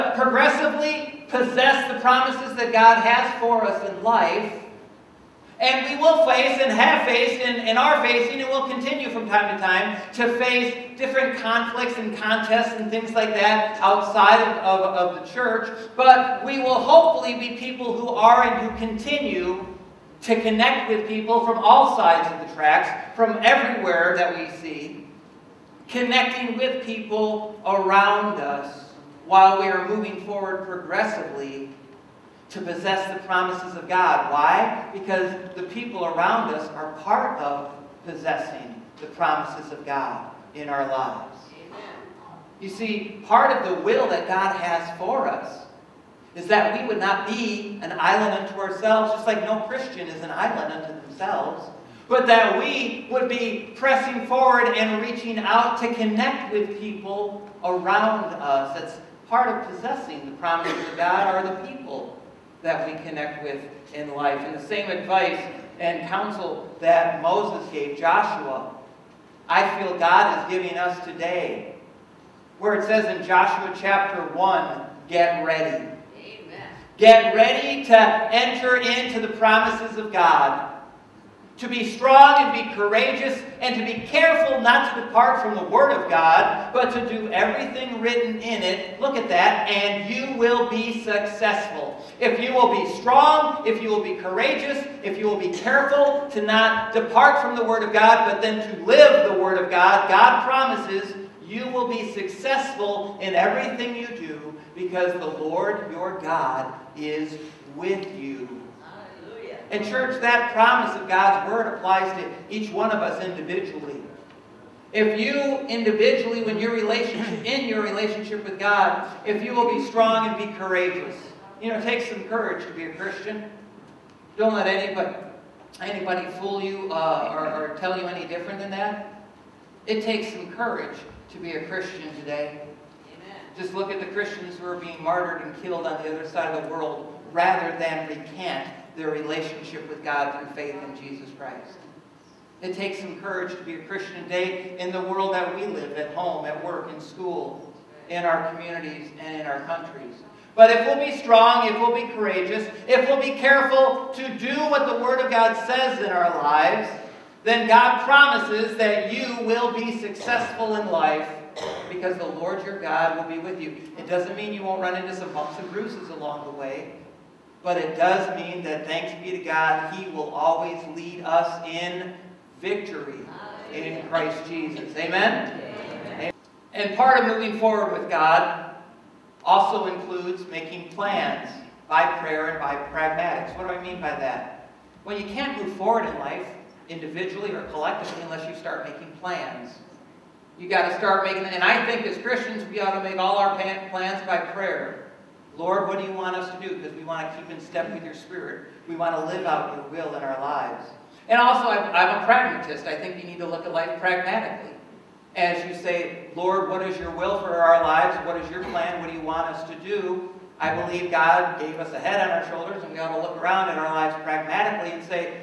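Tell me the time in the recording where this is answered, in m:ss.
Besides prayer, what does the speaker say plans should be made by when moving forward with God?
3:02.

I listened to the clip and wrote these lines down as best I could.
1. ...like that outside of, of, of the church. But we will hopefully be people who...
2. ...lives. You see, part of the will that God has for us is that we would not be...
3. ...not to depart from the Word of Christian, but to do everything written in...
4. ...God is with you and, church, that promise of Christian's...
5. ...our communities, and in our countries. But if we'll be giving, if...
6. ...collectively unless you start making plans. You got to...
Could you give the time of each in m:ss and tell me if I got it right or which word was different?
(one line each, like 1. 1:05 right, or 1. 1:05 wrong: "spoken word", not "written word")
1. 0:13 right
2. 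0:40 right
3. 1:24 wrong: "God", not "Christian"
4. 1:46 wrong: "God", not "Christian"
5. 2:28 wrong: "strong", not "giving"
6. 3:07 right.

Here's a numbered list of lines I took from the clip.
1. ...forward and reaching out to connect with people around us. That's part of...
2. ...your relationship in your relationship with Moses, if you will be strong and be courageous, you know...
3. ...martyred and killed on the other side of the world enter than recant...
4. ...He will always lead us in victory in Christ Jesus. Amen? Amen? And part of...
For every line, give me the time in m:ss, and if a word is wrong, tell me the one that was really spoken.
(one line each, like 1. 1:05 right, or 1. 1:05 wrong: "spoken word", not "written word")
1. 0:54 right
2. 1:56 wrong: "God", not "Moses"
3. 2:15 wrong: "rather", not "enter"
4. 2:49 right.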